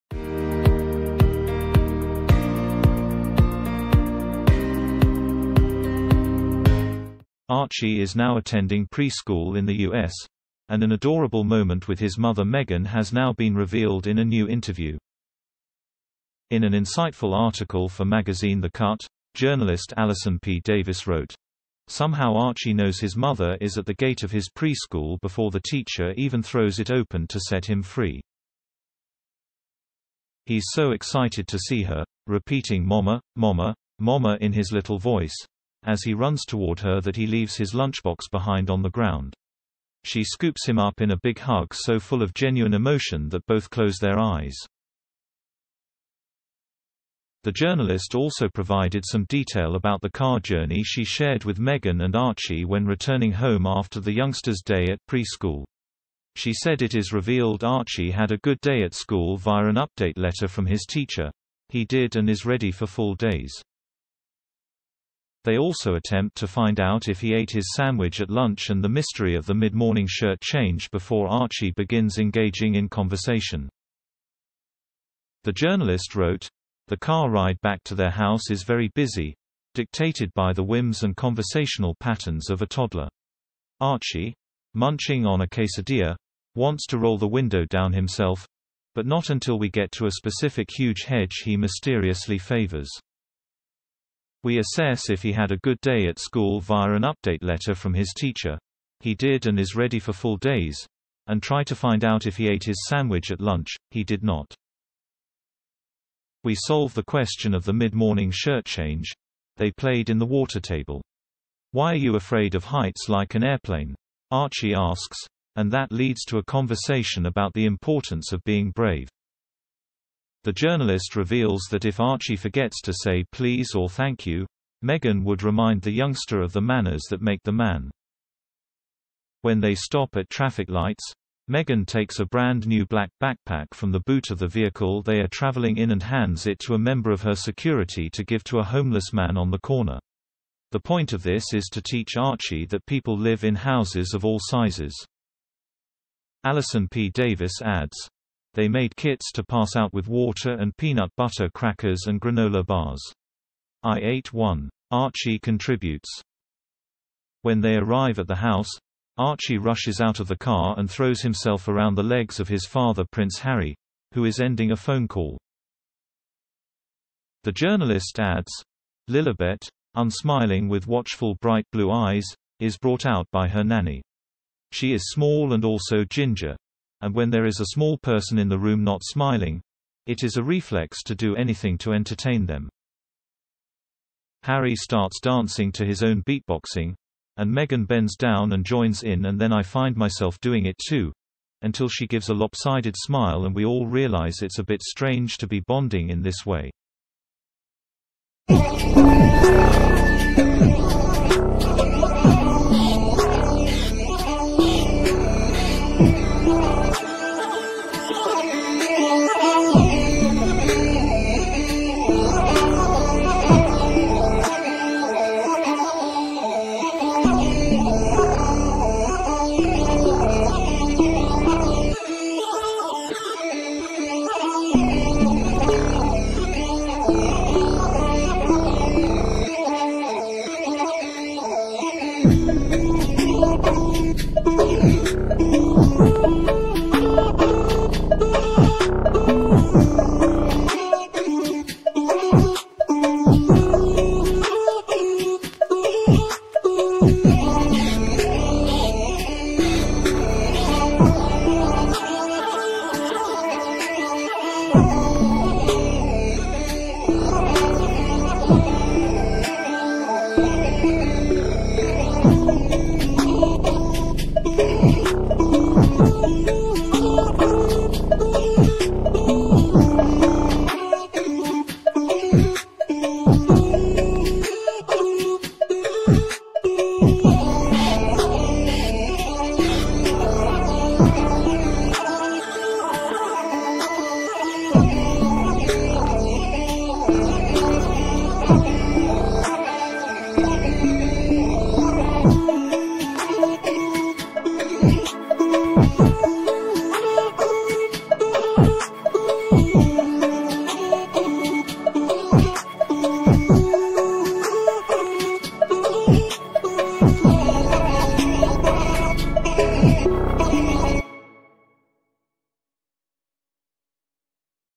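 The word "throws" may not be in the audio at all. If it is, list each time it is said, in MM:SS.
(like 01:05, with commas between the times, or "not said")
00:26, 02:40.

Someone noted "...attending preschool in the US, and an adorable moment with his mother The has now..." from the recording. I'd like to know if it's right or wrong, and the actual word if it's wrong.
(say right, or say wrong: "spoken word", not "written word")
wrong: "Meghan", not "The".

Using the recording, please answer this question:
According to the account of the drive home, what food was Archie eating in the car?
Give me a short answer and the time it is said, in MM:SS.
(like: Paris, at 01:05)
quesadilla, at 01:25.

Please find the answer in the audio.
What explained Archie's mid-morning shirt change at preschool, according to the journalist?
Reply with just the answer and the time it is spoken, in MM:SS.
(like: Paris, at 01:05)
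water table, at 01:50.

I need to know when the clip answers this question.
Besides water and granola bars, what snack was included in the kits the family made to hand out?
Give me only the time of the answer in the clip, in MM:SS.
02:30.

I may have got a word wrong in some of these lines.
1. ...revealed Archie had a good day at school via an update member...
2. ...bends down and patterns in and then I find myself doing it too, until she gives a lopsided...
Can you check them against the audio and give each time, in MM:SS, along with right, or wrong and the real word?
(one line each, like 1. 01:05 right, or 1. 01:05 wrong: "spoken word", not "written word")
1. 00:57 wrong: "letter", not "member"
2. 03:07 wrong: "joins", not "patterns".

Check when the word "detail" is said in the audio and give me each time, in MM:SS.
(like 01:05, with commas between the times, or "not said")
00:49.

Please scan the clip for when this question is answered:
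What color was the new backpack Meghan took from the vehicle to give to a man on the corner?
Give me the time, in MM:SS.
02:12.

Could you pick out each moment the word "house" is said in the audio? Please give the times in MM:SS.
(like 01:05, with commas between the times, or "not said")
01:18, 02:23, 02:38.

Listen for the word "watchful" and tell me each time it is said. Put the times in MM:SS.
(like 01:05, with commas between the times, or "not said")
02:50.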